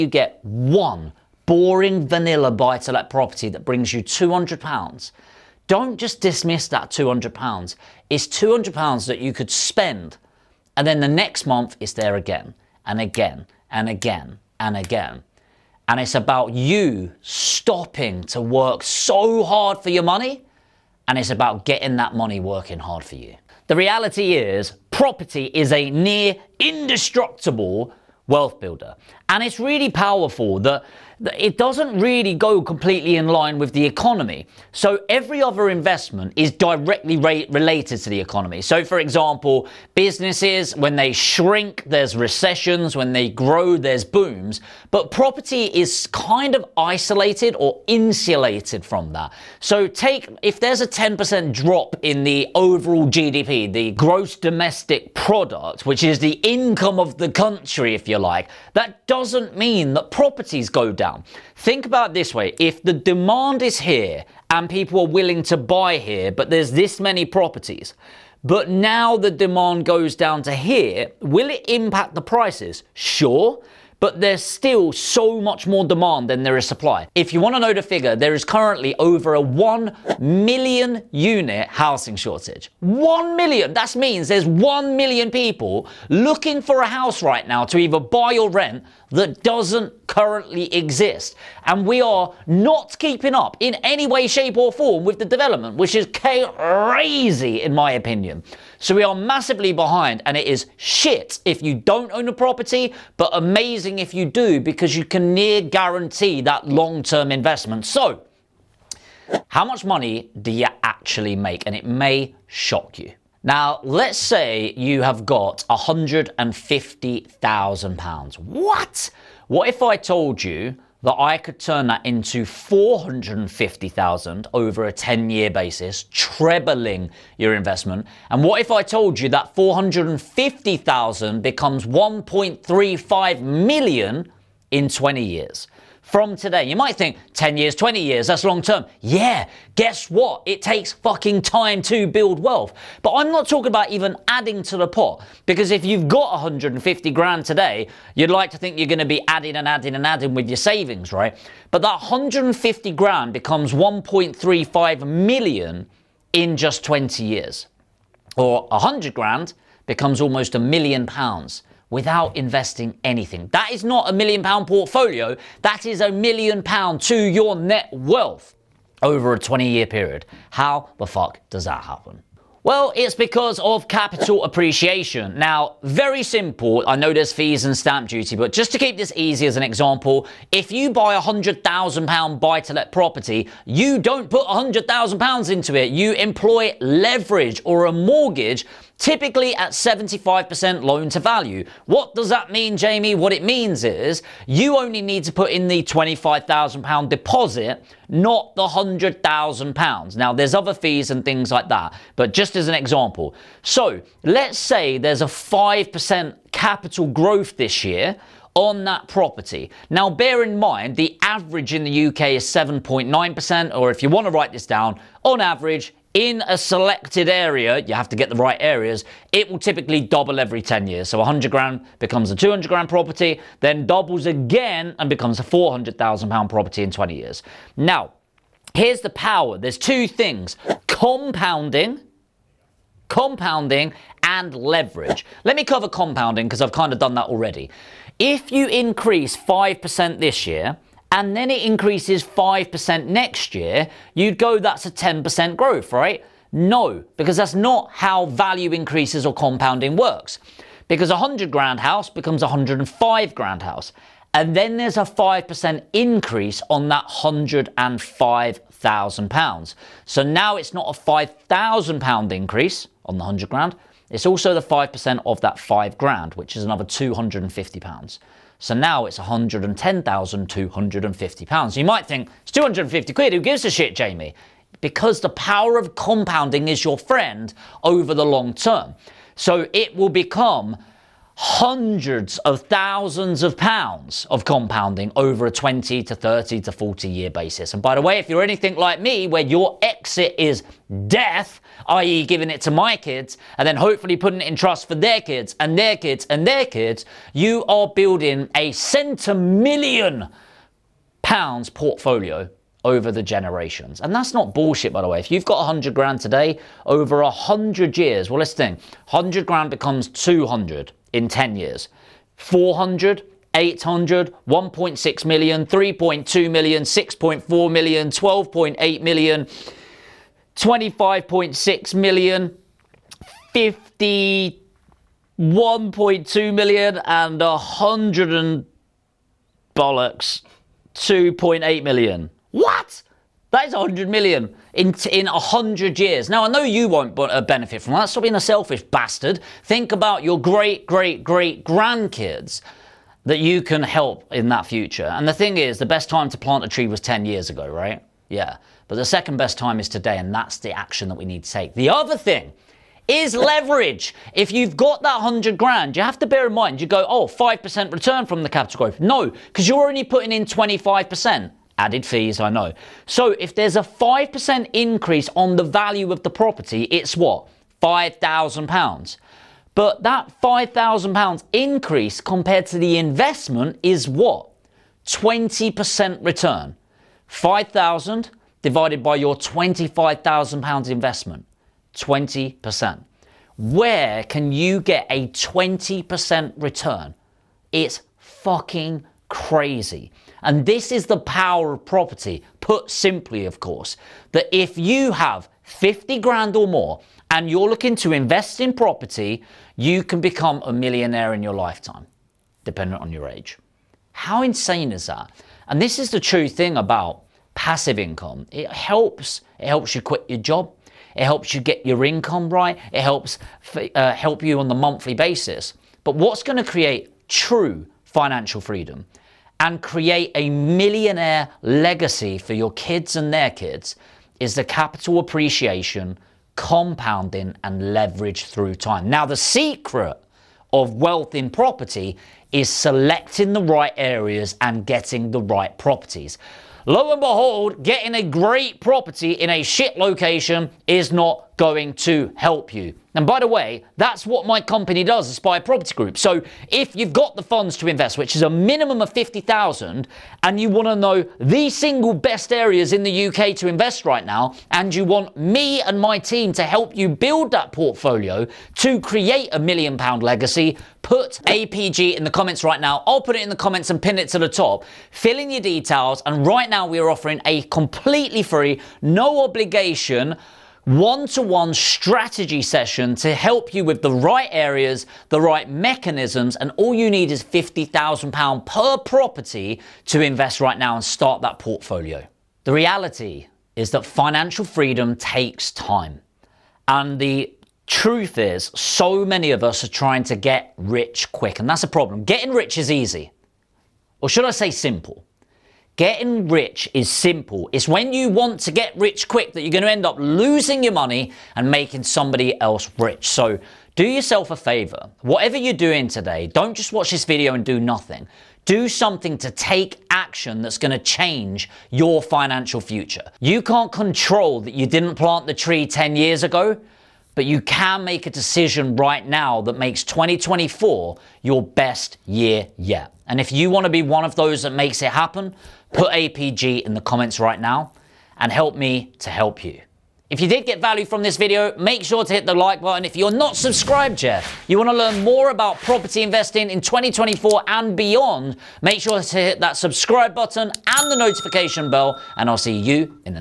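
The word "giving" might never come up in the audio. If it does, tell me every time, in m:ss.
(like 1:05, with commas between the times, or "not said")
4:52.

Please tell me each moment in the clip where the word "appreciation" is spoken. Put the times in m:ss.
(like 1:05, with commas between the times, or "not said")
2:54, 7:05.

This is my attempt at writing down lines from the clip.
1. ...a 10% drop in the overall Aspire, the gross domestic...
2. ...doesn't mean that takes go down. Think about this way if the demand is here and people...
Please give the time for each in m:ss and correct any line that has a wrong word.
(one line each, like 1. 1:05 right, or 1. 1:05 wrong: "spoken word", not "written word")
1. 0:50 wrong: "GDP", not "Aspire"
2. 0:59 wrong: "properties", not "takes".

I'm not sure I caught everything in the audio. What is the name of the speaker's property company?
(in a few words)
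Aspire Property Group.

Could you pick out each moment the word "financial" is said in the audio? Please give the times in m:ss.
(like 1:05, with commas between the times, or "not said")
6:58, 8:04, 8:32.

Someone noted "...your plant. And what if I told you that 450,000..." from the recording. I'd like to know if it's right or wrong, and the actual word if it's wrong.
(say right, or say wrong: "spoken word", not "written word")
wrong: "investment", not "plant".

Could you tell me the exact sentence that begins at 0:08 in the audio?
It's £200 that you could spend, and then the next month it's there again, and again, and again, and again.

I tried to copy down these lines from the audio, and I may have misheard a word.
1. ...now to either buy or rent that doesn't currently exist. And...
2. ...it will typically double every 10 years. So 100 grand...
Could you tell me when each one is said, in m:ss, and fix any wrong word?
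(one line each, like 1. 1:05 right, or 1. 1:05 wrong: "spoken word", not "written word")
1. 1:27 right
2. 3:39 right.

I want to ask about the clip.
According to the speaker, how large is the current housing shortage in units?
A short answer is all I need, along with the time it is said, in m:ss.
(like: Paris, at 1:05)
over 1 million, at 1:18.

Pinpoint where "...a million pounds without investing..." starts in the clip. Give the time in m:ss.
2:40.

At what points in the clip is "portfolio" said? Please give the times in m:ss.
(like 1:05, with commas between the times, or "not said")
2:44, 5:01, 7:37, 8:01.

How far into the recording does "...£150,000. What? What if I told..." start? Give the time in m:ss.
1:55.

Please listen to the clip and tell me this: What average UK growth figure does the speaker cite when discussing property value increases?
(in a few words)
7.9%.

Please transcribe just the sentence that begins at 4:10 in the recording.
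Because a 100 grand house becomes a 105 grand house.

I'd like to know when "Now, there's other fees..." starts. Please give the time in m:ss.
3:20.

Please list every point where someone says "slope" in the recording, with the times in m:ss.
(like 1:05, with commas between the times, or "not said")
not said.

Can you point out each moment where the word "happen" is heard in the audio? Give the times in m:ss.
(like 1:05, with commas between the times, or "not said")
2:51, 8:45.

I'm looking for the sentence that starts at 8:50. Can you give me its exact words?
If you did get value from this video, make sure to hit the like button.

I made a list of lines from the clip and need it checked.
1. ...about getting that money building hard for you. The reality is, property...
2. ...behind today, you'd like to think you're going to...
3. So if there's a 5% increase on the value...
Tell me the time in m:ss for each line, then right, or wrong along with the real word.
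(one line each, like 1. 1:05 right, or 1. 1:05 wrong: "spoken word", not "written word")
1. 0:21 wrong: "working", not "building"
2. 2:27 wrong: "grand", not "behind"
3. 6:03 right.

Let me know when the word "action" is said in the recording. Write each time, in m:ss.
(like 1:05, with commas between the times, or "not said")
5:50, 8:30.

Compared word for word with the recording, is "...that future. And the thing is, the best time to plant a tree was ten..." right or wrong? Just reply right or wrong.
right.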